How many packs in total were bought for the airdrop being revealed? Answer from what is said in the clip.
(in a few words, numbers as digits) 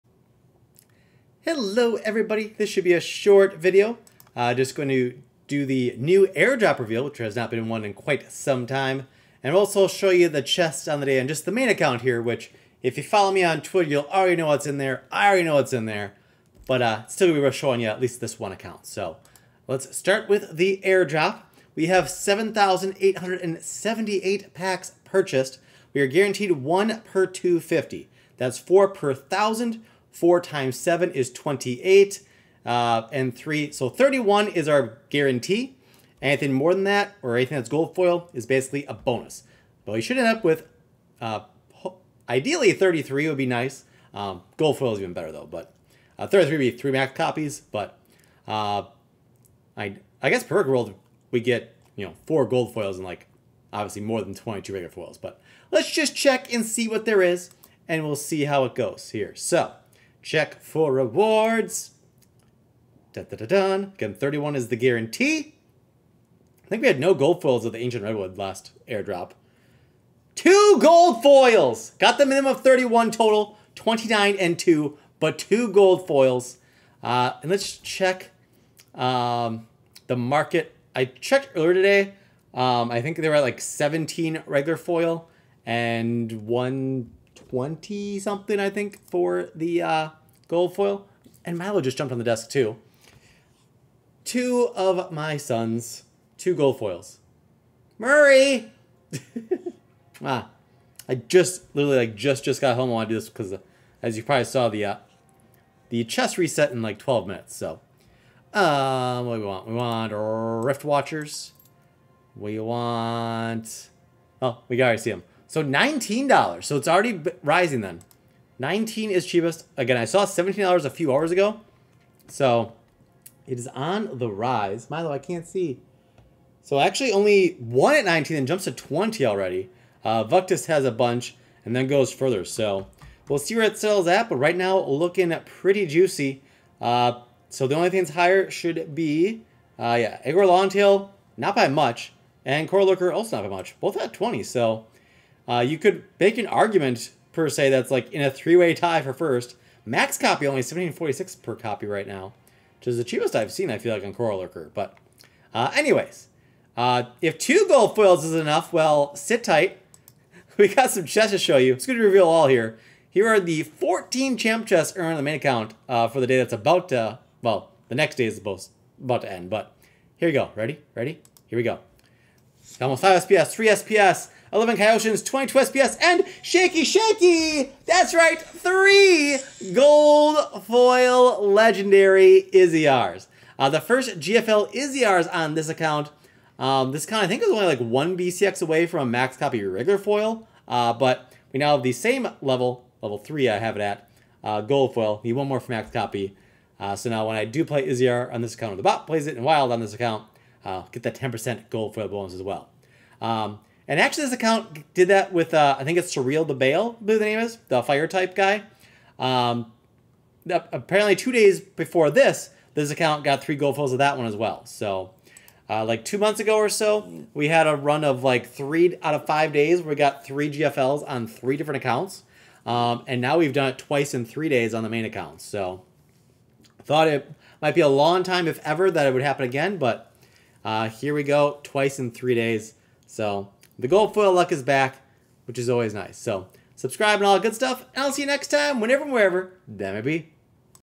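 7,878.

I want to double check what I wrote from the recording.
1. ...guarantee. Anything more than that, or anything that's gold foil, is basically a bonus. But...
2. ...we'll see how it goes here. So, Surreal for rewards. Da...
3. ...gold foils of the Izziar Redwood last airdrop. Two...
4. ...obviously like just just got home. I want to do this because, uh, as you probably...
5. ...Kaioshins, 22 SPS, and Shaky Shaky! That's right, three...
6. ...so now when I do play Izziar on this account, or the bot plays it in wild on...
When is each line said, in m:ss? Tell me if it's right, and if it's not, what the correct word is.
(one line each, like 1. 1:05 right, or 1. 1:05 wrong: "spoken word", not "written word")
1. 0:35 right
2. 0:58 wrong: "Check", not "Surreal"
3. 1:07 wrong: "Ancient", not "Izziar"
4. 1:41 wrong: "literally", not "obviously"
5. 2:54 right
6. 3:16 right.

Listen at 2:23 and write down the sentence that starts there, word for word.
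Both at 20, so uh, you could make an argument per se that's like in a three-way tie for first.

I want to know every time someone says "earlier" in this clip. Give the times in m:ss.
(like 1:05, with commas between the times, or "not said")
1:21.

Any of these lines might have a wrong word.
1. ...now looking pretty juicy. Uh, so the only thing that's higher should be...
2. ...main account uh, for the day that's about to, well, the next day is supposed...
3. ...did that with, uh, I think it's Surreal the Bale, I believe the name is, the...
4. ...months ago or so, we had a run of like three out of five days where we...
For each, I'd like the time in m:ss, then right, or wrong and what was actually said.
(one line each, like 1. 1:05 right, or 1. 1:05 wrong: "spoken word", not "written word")
1. 2:14 right
2. 2:45 right
3. 3:24 right
4. 3:36 right.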